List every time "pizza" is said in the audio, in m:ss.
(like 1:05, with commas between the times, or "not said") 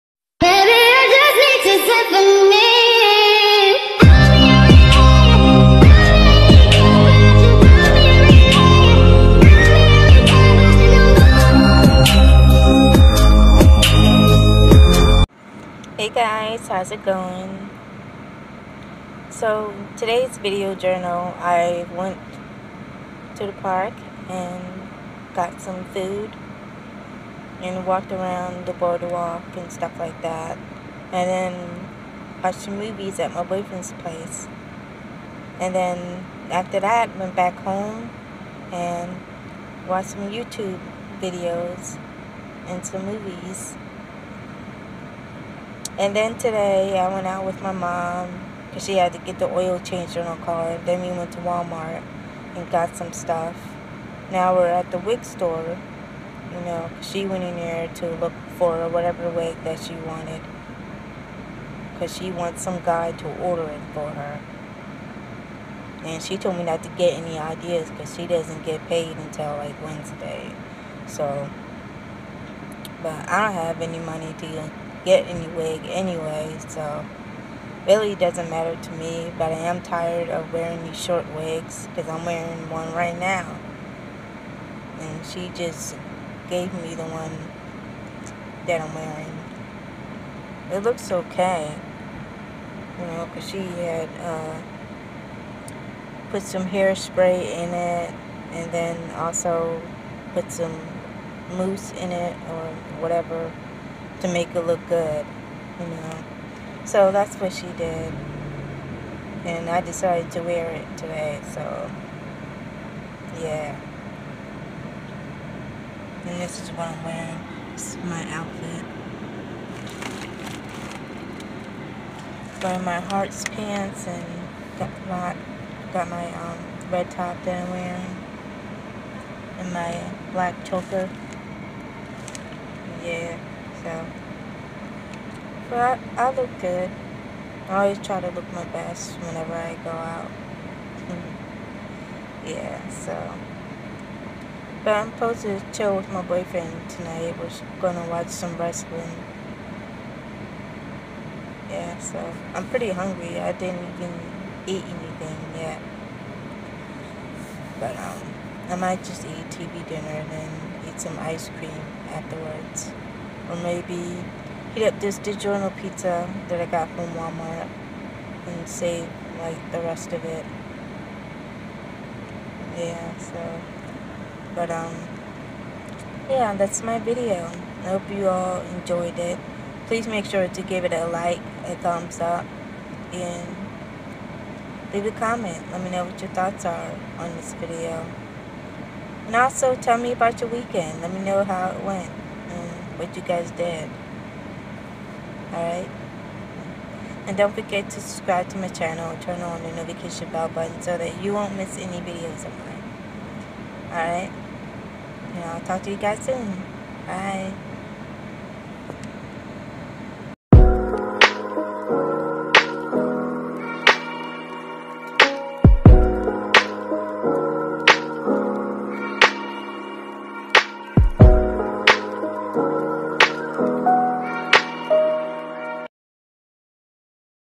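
2:45.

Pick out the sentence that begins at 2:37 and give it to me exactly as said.
But um, I might just eat TV dinner and then eat some ice cream afterwards.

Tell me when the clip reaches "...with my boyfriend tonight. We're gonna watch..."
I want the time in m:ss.
2:25.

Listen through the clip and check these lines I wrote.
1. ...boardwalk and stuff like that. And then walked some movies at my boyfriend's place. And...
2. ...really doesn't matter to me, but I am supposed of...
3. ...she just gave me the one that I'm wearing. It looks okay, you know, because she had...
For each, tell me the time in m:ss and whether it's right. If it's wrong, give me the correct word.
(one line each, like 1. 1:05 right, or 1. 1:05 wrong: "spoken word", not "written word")
1. 0:28 wrong: "watched", not "walked"
2. 1:17 wrong: "tired", not "supposed"
3. 1:25 right.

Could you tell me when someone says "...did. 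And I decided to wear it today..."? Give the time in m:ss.
1:47.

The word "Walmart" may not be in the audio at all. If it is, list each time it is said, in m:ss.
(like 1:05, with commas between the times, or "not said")
0:51, 2:47.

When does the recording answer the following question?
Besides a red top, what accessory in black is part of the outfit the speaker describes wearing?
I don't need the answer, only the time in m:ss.
2:10.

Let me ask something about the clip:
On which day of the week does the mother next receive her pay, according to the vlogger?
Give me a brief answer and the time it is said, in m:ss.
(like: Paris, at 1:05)
Wednesday, at 1:09.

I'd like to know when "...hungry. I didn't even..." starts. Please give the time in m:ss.
2:32.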